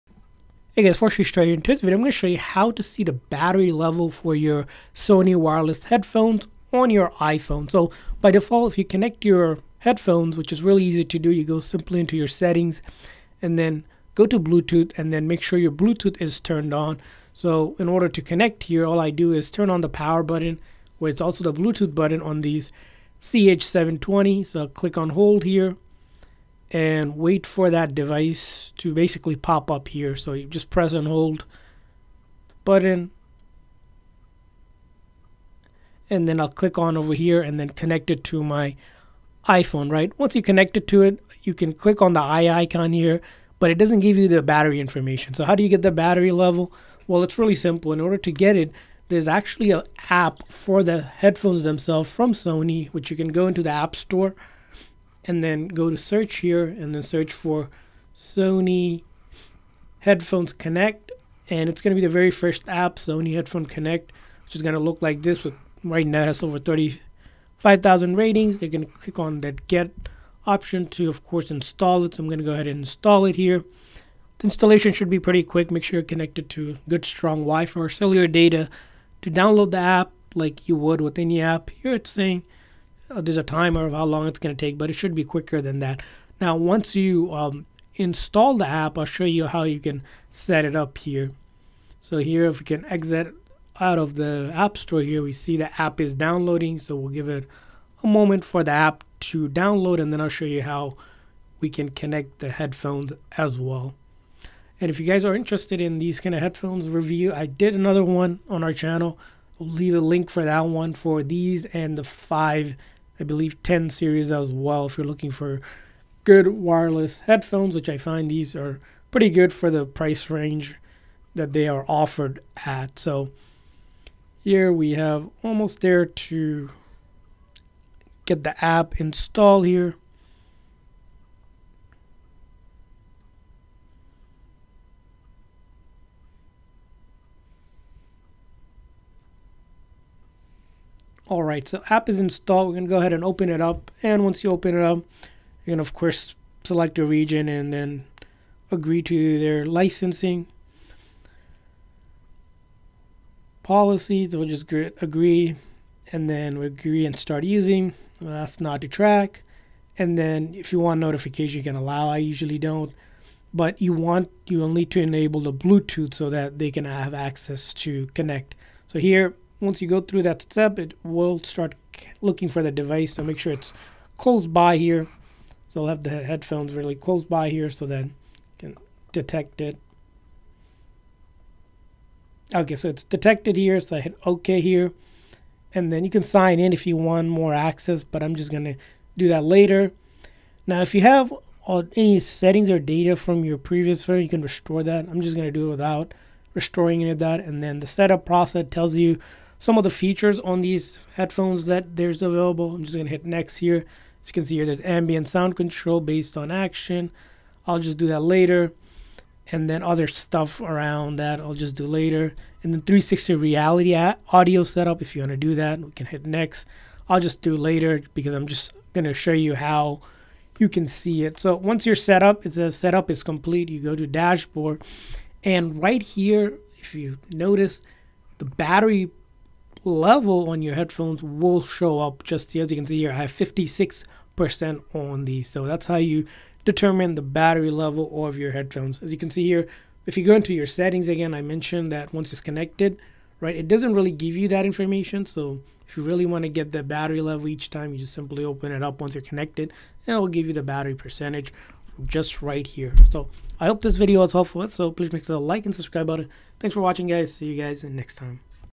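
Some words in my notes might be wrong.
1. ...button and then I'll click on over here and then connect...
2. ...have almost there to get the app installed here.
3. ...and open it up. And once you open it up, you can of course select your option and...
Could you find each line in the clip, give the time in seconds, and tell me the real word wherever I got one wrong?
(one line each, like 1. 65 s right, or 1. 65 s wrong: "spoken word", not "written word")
1. 32 s right
2. 124 s right
3. 143 s wrong: "region", not "option".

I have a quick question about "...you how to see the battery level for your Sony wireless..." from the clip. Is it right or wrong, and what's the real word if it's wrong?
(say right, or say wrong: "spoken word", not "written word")
right.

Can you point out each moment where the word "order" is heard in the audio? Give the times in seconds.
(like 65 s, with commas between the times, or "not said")
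17 s, 47 s.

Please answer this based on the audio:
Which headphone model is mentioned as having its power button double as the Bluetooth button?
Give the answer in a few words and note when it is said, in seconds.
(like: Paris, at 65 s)
CH720, at 23 s.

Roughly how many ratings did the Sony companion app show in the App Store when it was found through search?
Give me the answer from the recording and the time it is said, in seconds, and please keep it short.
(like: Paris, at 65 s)
Over 35,000, at 66 s.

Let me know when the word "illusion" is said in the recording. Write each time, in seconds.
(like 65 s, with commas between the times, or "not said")
not said.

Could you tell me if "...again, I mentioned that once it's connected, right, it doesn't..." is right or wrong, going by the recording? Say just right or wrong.
right.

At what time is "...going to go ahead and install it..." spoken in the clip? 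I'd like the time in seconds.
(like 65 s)
72 s.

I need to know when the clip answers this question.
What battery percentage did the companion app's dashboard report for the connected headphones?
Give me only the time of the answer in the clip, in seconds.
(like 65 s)
233 s.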